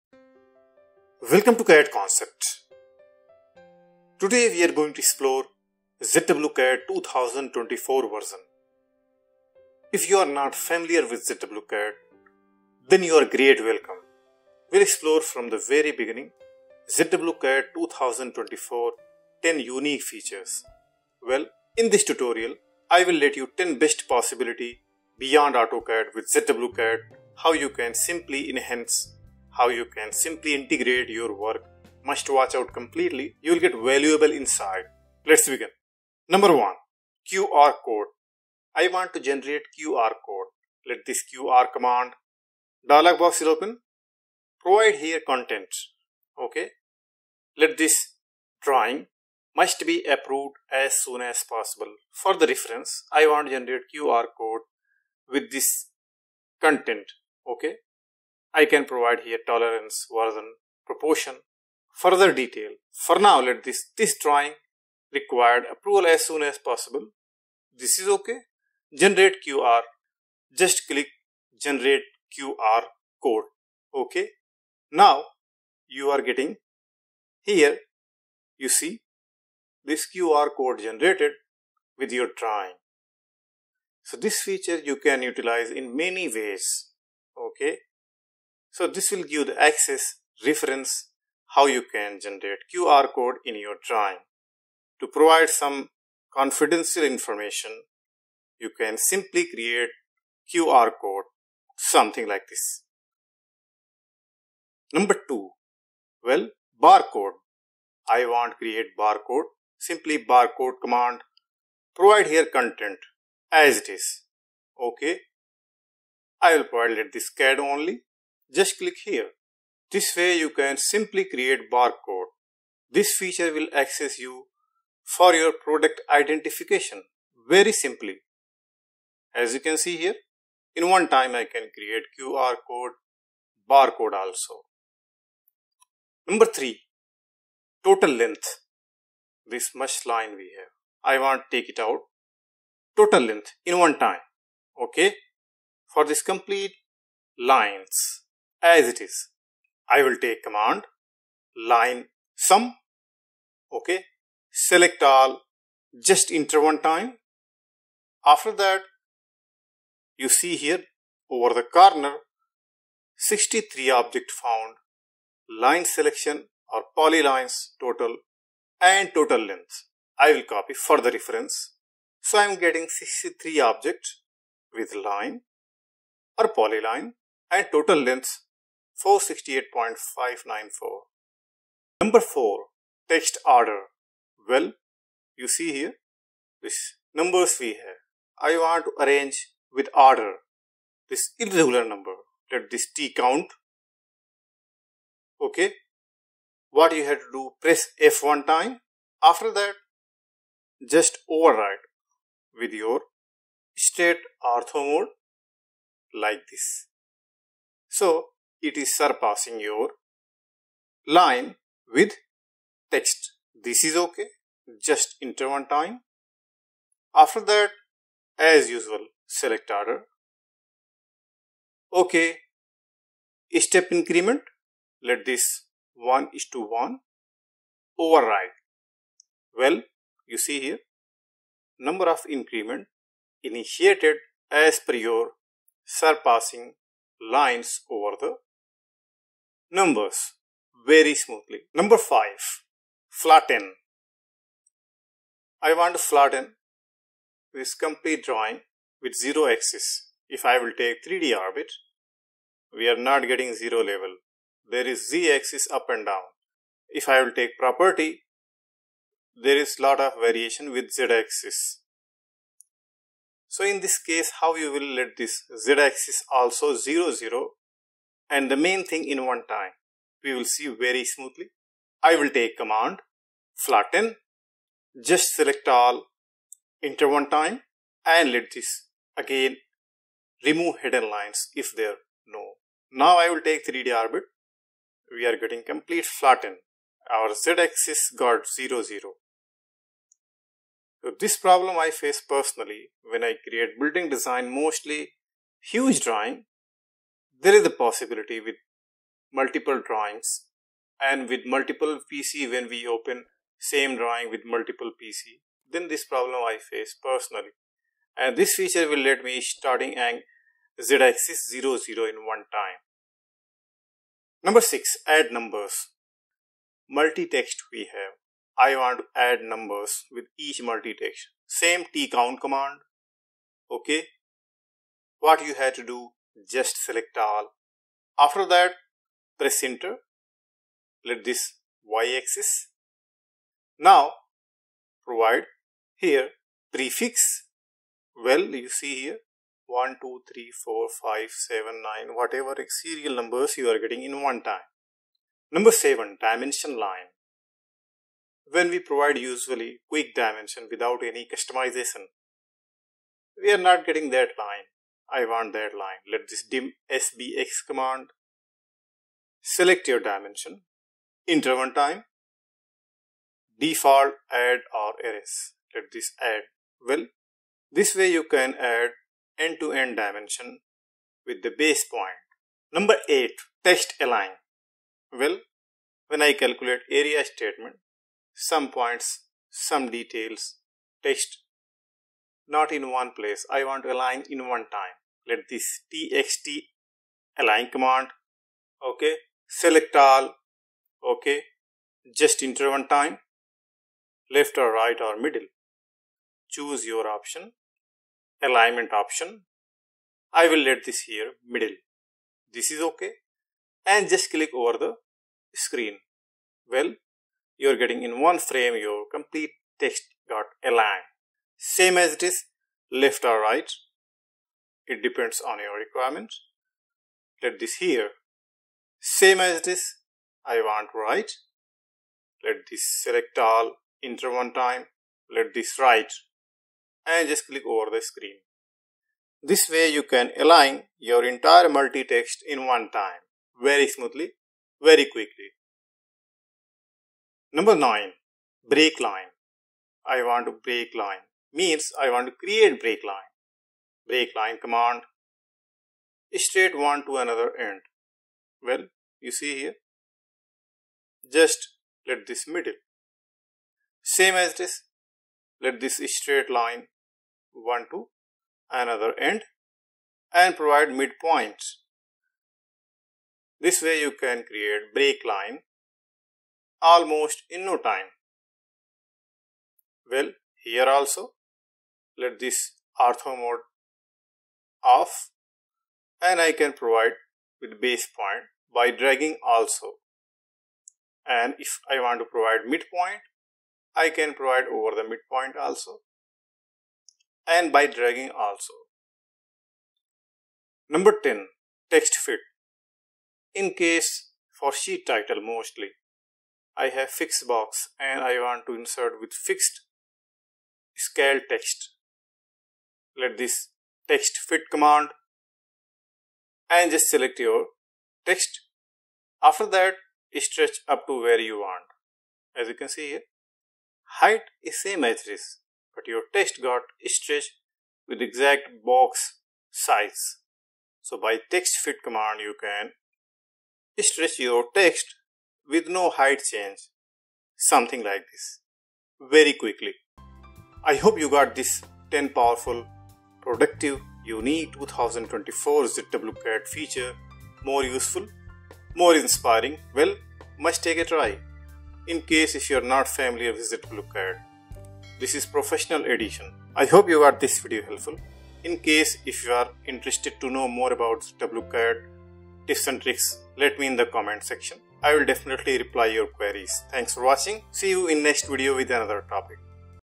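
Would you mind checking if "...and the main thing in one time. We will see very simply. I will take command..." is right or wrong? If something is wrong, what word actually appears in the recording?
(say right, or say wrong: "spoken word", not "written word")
wrong: "smoothly", not "simply".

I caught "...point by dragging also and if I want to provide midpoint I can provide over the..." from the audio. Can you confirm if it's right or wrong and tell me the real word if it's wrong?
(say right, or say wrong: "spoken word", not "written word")
right.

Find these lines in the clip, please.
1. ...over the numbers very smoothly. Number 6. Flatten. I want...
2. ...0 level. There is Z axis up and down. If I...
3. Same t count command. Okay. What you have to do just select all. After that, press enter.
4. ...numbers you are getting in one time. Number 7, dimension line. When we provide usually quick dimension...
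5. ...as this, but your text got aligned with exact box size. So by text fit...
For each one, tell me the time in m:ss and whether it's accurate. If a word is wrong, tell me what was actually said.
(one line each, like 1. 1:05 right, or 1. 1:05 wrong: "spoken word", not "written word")
1. 3:57 wrong: "5", not "6"
2. 4:13 right
3. 5:21 right
4. 5:43 right
5. 8:35 wrong: "stretched", not "aligned".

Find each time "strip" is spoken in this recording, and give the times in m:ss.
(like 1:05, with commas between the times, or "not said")
not said.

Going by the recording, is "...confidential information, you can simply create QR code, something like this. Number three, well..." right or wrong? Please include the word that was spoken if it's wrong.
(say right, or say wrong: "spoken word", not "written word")
wrong: "two", not "three".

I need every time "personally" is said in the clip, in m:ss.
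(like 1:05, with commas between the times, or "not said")
4:52, 5:07.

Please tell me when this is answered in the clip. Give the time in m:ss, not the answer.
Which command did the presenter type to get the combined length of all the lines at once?
2:32.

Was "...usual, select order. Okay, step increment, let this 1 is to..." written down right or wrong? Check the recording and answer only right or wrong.
right.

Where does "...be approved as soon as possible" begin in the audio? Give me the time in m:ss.
0:49.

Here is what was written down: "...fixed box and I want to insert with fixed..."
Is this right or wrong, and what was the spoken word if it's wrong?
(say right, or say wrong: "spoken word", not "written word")
right.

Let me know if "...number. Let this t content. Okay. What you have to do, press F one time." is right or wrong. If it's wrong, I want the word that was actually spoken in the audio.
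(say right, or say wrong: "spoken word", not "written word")
wrong: "count", not "content".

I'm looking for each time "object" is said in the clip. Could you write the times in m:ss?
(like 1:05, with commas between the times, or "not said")
2:43, 2:53.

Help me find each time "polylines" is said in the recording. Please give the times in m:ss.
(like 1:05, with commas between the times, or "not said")
2:46, 2:56.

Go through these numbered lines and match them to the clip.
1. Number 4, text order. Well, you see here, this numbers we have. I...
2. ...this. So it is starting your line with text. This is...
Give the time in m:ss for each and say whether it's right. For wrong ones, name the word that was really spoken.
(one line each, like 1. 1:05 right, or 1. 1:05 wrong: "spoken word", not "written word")
1. 3:02 right
2. 3:26 wrong: "surpassing", not "starting".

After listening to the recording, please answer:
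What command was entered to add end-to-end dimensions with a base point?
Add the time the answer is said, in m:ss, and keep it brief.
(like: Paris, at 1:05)
dim sbx, at 5:56.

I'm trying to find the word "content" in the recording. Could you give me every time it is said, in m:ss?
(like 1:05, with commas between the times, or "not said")
0:45, 0:56, 1:52.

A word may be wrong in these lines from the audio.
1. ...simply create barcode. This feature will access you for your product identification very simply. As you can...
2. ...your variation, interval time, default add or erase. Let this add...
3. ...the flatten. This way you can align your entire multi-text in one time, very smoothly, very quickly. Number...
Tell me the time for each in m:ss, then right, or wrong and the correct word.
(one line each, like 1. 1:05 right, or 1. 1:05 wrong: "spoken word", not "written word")
1. 2:00 right
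2. 5:59 wrong: "dimension", not "variation"
3. 7:07 wrong: "screen", not "flatten".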